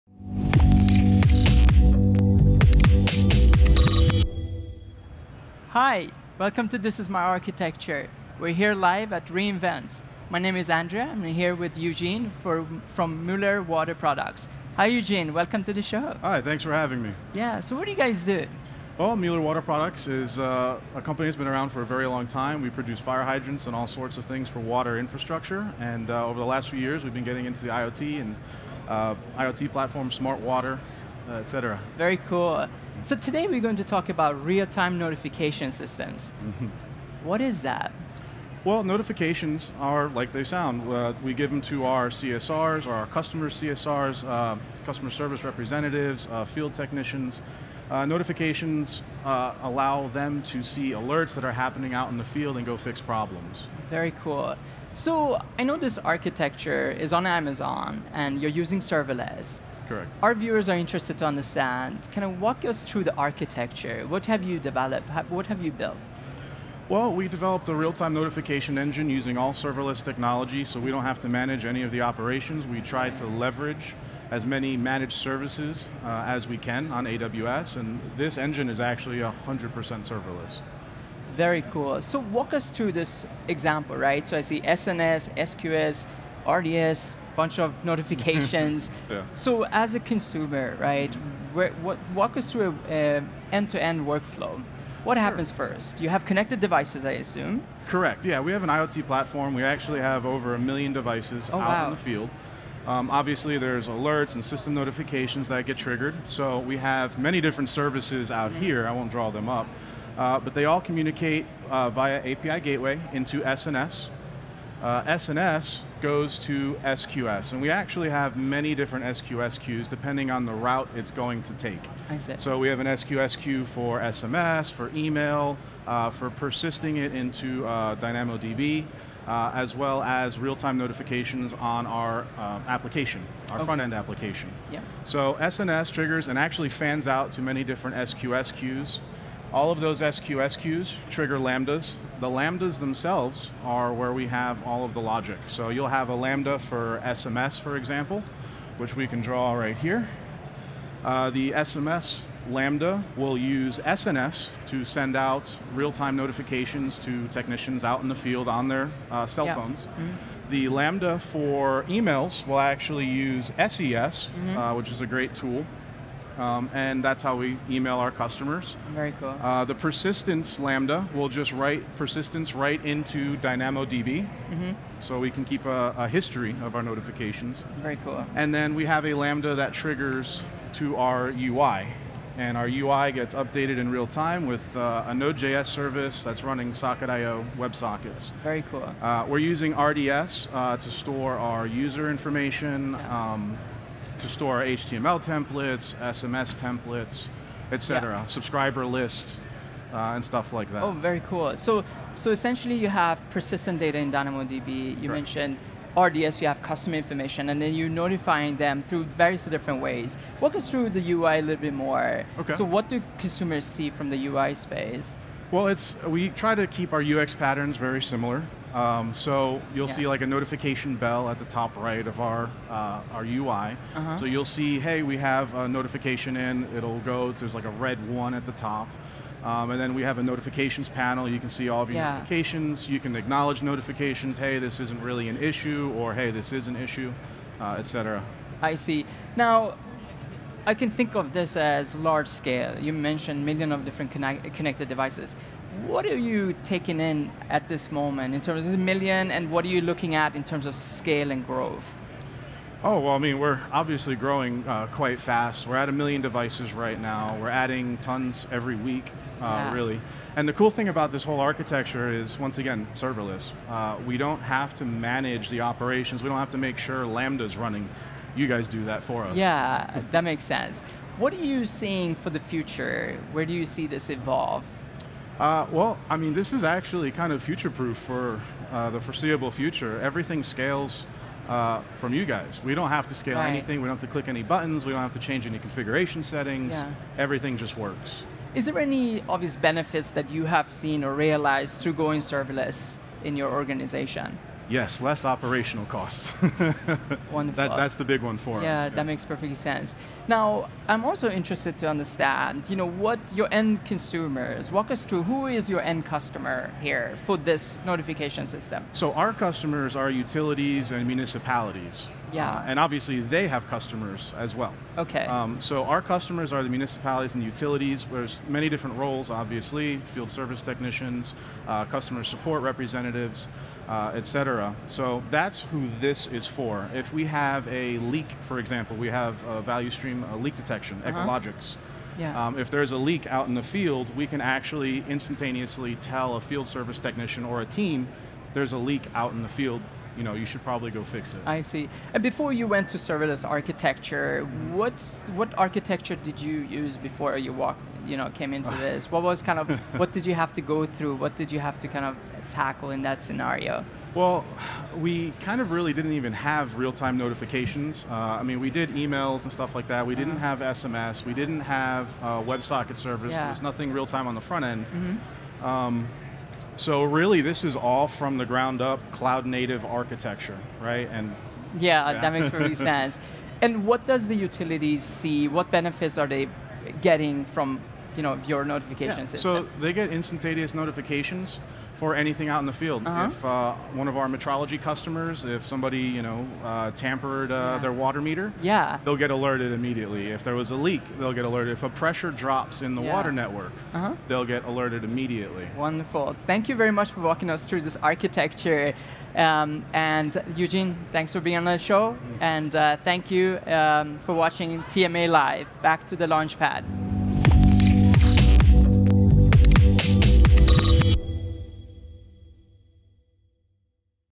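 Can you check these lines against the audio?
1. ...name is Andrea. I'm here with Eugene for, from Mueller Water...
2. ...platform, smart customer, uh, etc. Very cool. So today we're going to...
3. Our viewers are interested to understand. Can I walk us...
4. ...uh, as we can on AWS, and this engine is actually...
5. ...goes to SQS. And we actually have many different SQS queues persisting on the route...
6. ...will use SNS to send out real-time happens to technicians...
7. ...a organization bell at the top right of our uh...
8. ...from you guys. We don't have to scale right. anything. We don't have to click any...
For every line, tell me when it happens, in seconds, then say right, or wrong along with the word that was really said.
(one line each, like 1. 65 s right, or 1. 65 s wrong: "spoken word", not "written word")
1. 10 s right
2. 29 s wrong: "water", not "customer"
3. 60 s right
4. 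76 s right
5. 116 s wrong: "depending", not "persisting"
6. 153 s wrong: "notifications", not "happens"
7. 220 s wrong: "notification", not "organization"
8. 281 s right.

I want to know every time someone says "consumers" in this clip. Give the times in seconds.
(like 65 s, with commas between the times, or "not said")
89 s, 213 s, 303 s.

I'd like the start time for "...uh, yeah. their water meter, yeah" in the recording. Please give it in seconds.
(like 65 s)
387 s.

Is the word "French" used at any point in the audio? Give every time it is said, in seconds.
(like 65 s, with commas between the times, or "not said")
not said.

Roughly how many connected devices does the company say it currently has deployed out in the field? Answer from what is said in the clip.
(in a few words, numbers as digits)
Over 1 million.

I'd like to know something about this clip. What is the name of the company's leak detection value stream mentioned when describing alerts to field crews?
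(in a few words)
Echologics.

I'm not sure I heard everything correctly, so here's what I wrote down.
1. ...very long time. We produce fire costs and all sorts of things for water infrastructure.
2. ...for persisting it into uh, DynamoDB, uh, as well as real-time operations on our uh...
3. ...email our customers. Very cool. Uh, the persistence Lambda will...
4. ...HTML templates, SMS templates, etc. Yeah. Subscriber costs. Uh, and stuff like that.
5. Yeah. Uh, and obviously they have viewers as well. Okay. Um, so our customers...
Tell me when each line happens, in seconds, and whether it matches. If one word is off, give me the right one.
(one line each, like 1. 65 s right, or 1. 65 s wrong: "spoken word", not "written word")
1. 21 s wrong: "hydrants", not "costs"
2. 126 s wrong: "notifications", not "operations"
3. 167 s right
4. 194 s wrong: "lists", not "costs"
5. 312 s wrong: "customers", not "viewers".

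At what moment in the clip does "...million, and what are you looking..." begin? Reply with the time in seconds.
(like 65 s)
248 s.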